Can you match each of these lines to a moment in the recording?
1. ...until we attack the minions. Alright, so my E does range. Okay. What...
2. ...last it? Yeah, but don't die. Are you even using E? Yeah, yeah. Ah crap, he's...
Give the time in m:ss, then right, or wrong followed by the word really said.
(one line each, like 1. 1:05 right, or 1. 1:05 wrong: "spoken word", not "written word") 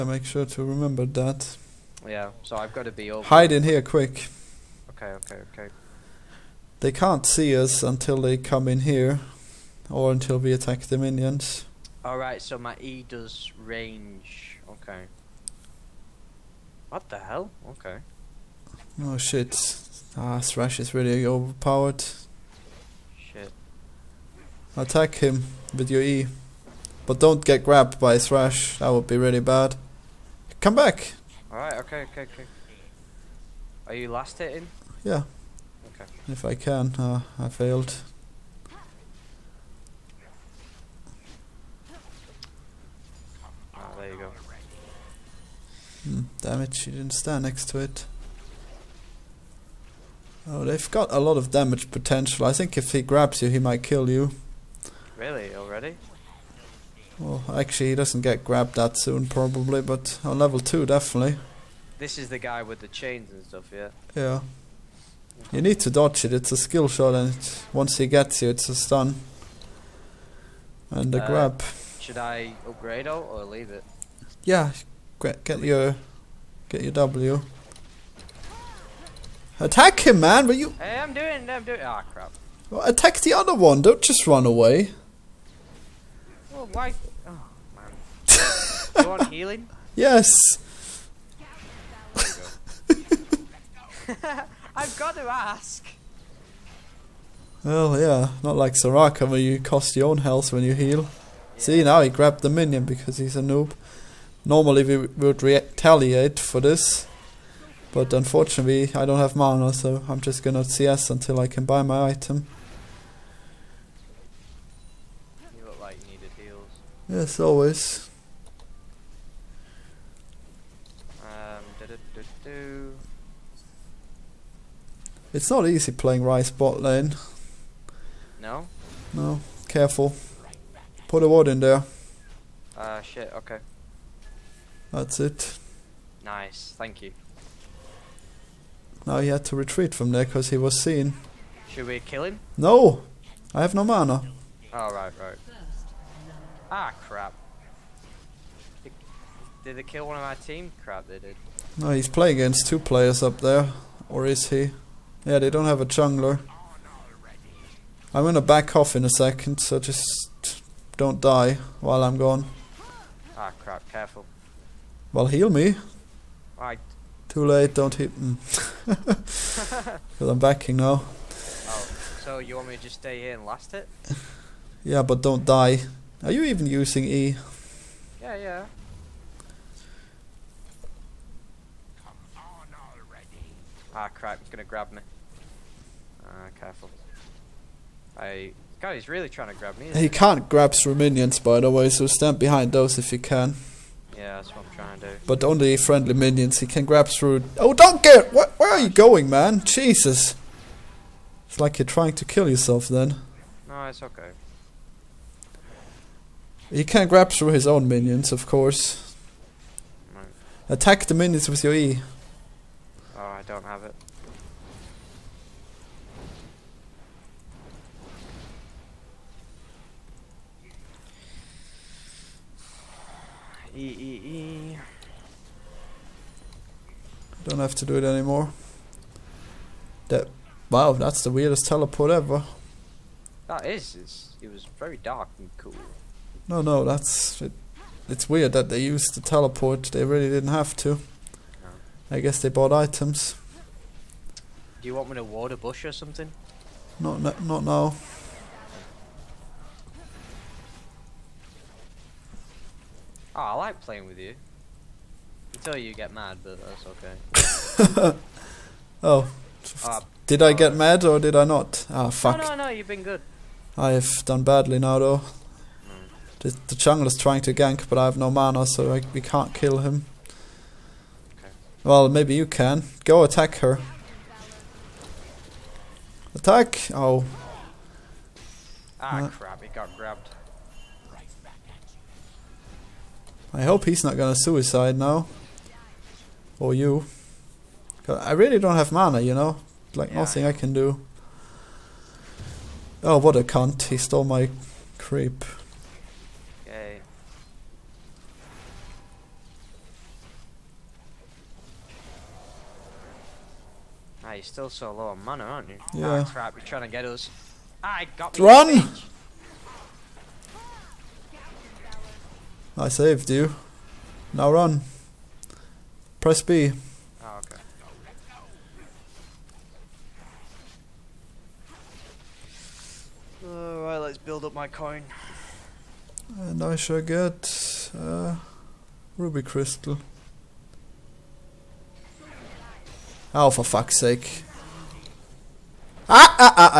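1. 0:10 right
2. 2:53 right.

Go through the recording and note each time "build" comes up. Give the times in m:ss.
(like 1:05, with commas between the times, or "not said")
5:24.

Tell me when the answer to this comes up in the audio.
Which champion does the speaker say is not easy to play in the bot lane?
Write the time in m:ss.
2:06.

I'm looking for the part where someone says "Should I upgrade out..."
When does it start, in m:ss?
1:11.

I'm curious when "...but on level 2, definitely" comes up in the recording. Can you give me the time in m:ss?
0:59.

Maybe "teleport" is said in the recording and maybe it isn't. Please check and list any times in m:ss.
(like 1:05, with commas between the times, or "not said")
3:51, 3:59.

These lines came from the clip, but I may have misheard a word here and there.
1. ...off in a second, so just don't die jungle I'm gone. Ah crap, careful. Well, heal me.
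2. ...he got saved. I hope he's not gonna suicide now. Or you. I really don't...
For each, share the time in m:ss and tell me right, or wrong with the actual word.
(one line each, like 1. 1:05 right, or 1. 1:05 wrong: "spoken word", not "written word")
1. 2:38 wrong: "while", not "jungle"
2. 4:39 wrong: "grabbed", not "saved".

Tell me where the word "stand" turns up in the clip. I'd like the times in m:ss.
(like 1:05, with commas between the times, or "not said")
0:47, 3:12.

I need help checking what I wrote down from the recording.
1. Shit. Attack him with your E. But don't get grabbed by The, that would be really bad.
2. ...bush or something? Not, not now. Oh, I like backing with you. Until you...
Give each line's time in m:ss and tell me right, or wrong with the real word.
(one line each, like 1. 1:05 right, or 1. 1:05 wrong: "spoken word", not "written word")
1. 0:23 wrong: "Thresh", not "The"
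2. 4:05 wrong: "playing", not "backing".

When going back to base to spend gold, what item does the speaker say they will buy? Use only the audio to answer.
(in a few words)
Ruby crystal.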